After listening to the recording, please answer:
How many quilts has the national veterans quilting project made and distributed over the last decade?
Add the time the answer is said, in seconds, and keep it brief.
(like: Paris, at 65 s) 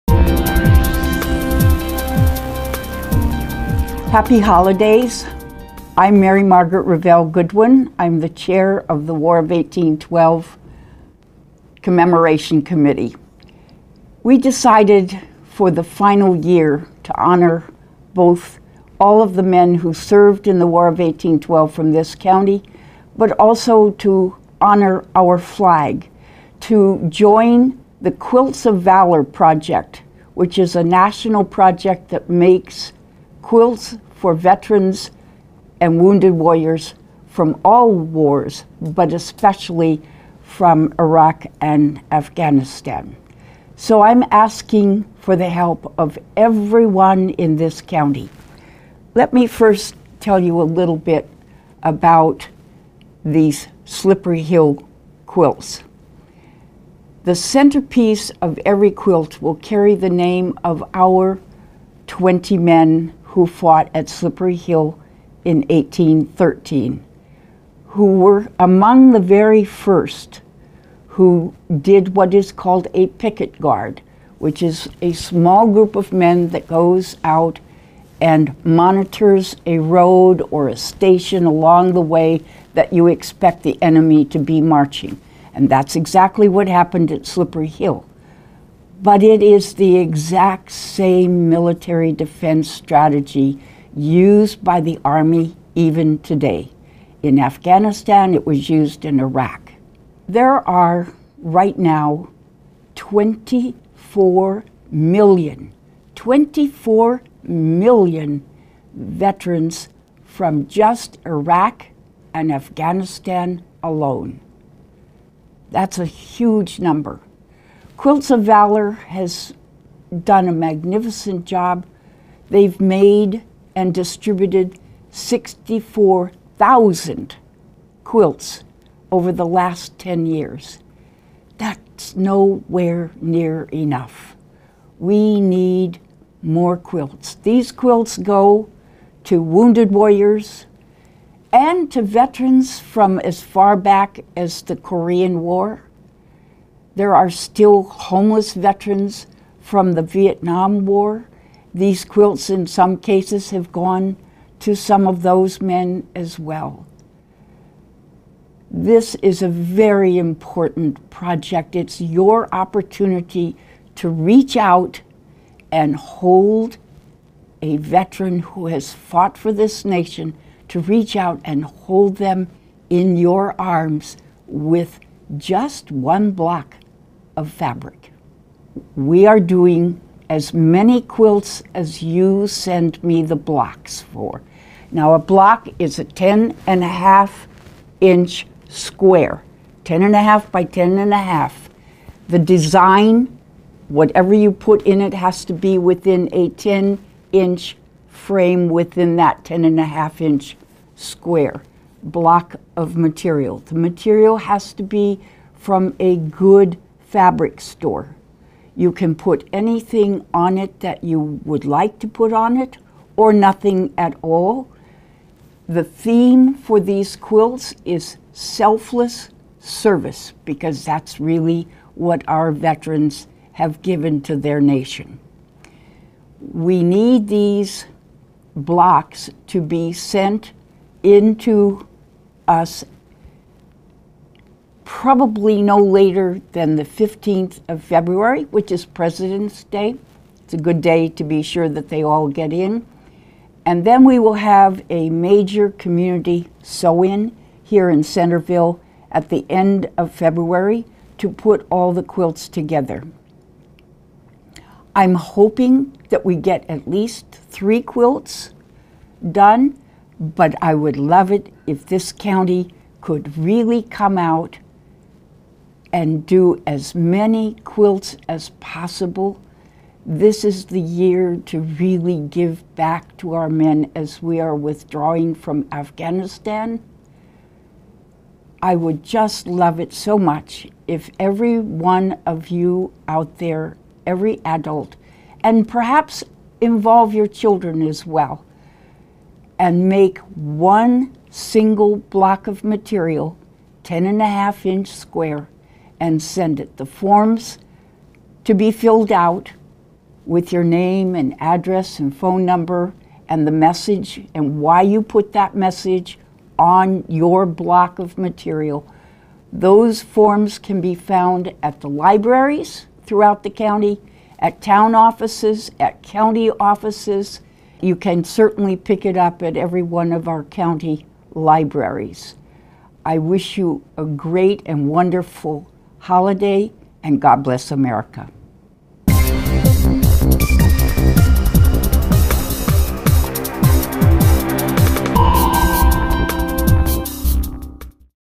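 64,000, at 125 s.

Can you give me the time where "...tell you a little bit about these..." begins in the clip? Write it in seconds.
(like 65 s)
50 s.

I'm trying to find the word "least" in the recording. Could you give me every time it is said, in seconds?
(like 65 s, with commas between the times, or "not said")
256 s.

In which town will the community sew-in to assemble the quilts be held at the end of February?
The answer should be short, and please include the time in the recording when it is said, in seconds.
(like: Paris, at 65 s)
Centreville, at 248 s.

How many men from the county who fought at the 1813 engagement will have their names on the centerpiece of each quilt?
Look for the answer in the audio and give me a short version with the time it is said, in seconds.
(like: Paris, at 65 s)
20, at 62 s.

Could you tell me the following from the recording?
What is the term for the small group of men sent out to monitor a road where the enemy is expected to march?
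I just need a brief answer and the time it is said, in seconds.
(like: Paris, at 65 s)
picket guard, at 73 s.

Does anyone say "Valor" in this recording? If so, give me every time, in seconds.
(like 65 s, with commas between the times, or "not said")
28 s, 118 s.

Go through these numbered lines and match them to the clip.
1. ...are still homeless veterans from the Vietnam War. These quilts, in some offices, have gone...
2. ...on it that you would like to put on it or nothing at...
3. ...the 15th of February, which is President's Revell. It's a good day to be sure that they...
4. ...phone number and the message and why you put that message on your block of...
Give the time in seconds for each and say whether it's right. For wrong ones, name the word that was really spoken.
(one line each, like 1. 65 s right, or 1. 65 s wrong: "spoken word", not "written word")
1. 147 s wrong: "cases", not "offices"
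2. 210 s right
3. 236 s wrong: "Day", not "Revell"
4. 302 s right.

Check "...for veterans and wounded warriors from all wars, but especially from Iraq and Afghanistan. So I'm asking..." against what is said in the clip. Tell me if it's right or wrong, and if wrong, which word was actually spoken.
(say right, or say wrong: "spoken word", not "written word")
right.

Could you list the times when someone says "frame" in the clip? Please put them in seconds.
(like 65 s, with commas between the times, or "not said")
198 s.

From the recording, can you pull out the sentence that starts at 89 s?
But it is the exact same military defense strategy used by the Army even today.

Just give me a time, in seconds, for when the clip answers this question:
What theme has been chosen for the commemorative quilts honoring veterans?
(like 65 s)
218 s.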